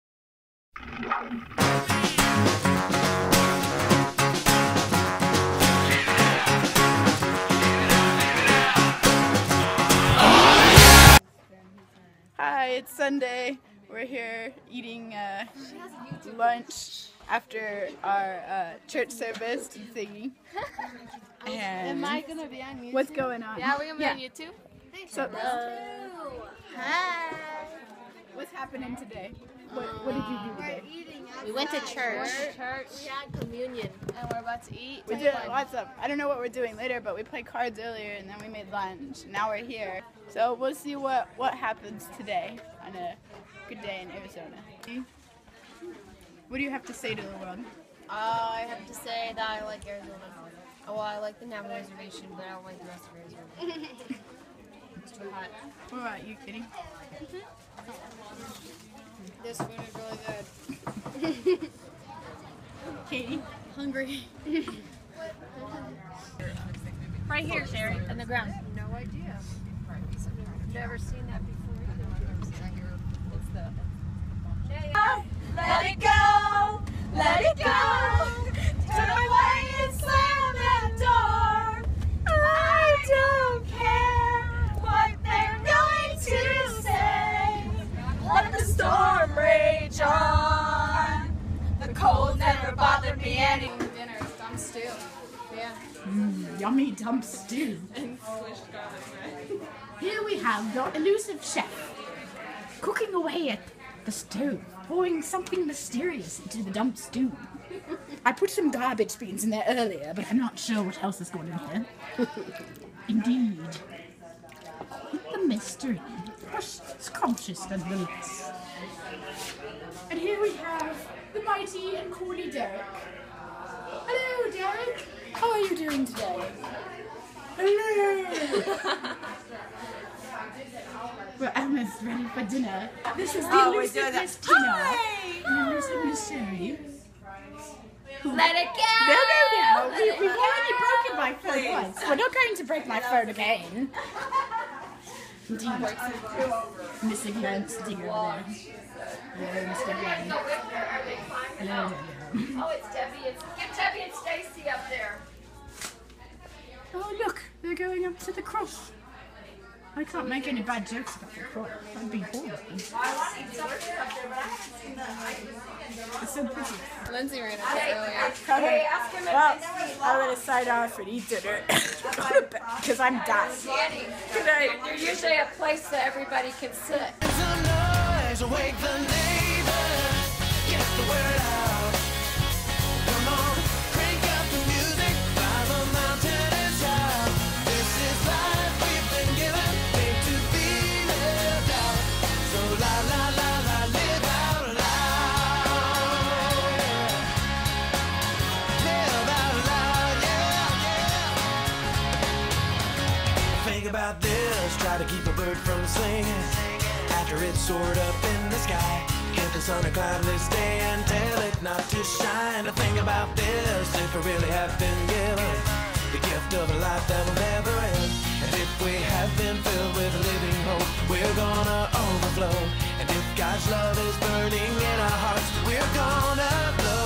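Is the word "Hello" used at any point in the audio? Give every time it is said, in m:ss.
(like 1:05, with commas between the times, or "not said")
0:25, 2:03, 2:07.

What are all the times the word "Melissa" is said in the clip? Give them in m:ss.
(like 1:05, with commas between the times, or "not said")
not said.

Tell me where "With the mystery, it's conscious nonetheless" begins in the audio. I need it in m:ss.
1:55.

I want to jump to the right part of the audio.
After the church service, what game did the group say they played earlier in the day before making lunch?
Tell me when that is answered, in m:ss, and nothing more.
0:37.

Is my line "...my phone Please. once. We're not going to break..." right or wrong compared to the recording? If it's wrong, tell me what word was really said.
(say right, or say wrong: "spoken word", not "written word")
right.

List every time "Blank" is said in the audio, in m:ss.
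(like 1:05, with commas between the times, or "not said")
2:29.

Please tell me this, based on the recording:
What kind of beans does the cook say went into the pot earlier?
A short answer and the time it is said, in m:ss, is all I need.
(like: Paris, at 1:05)
garbage beans, at 1:48.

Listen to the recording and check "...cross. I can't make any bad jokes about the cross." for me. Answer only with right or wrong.
right.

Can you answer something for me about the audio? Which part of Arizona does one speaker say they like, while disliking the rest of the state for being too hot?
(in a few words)
Navajo Reservation.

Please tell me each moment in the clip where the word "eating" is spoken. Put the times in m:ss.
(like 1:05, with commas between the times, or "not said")
0:14.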